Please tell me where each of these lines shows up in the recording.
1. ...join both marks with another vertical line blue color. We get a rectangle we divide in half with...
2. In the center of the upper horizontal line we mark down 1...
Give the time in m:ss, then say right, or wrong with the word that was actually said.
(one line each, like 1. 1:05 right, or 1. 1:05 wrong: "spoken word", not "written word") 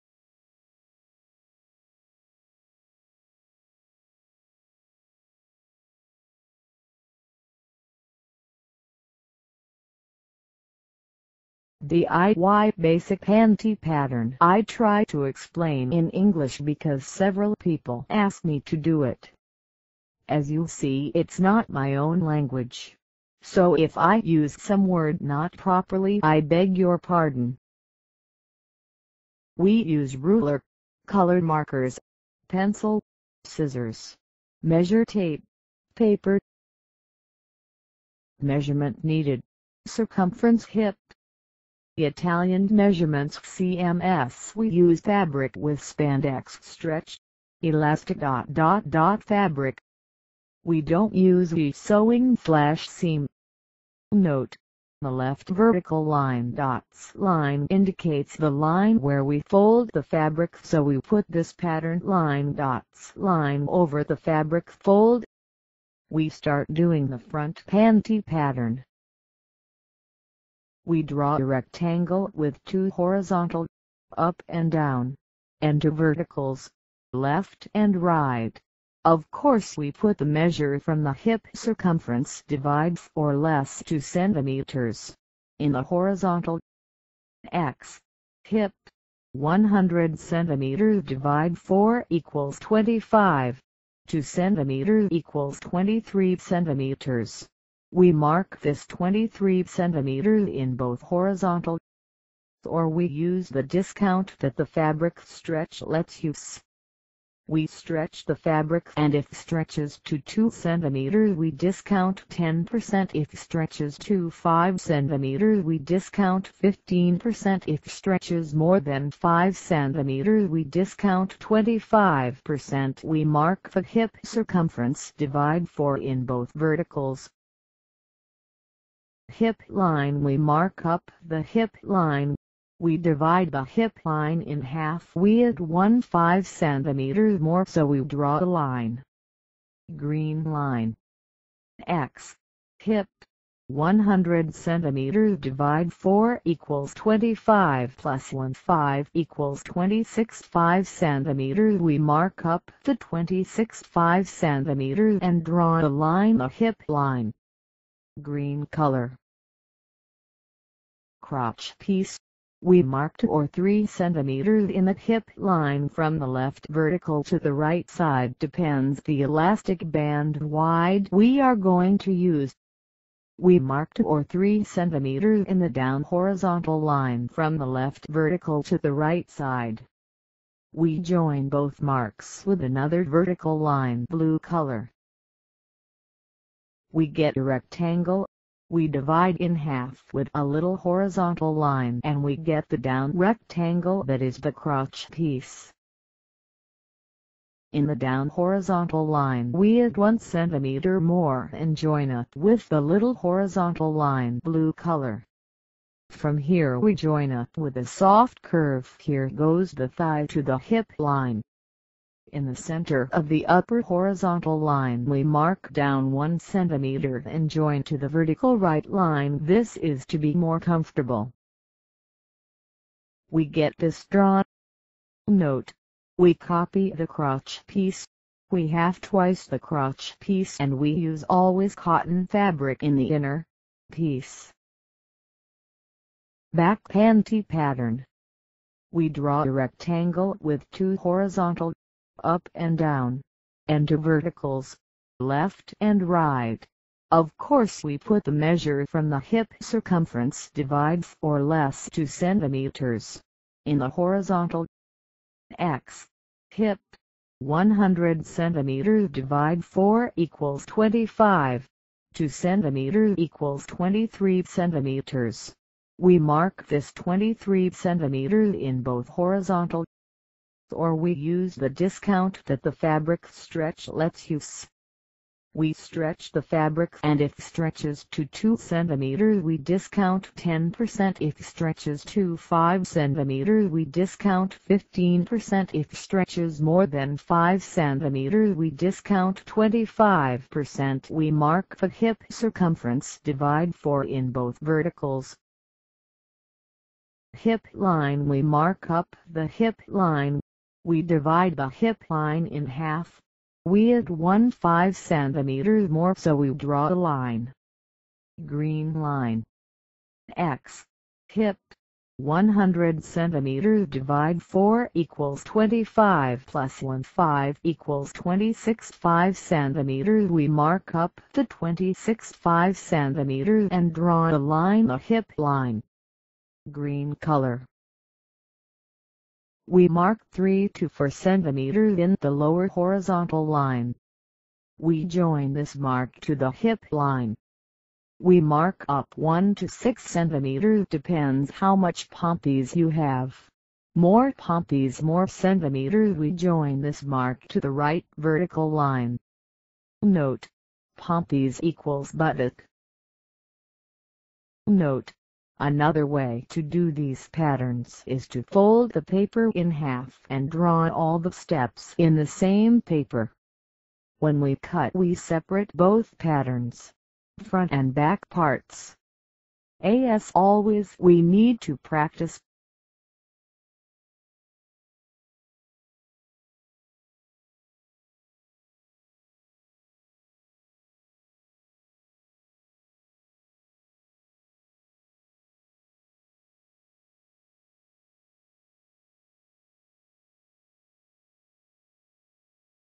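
1. 3:00 right
2. 3:32 right.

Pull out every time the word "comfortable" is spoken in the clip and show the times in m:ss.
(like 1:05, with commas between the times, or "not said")
3:40.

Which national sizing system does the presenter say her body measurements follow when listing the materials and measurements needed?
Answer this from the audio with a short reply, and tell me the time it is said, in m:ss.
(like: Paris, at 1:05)
Italian, at 0:42.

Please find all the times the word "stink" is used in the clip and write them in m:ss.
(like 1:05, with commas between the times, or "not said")
not said.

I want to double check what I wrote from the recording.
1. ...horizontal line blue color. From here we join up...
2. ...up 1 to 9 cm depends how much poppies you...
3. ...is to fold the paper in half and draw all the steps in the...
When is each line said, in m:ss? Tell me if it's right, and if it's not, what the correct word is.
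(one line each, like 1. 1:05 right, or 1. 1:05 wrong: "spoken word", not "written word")
1. 3:23 right
2. 5:38 wrong: "6", not "9"
3. 5:58 right.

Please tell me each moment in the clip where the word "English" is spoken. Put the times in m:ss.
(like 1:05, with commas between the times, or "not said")
0:16.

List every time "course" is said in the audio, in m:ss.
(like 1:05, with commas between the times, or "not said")
1:19, 4:07.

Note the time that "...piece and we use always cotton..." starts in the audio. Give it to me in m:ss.
3:50.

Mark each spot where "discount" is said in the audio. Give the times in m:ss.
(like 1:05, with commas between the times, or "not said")
1:43, 1:51, 1:55, 2:00, 4:31, 4:39, 4:43, 4:48.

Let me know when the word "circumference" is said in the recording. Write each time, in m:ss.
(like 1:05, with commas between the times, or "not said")
0:39, 1:21, 2:04, 4:09, 4:52.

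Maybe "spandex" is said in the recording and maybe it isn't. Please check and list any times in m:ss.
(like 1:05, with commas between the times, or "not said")
0:45.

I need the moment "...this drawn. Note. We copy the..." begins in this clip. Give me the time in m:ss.
3:43.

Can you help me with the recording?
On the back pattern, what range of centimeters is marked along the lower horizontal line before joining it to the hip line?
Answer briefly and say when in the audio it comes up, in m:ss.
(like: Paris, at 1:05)
3 to 4 cm, at 5:30.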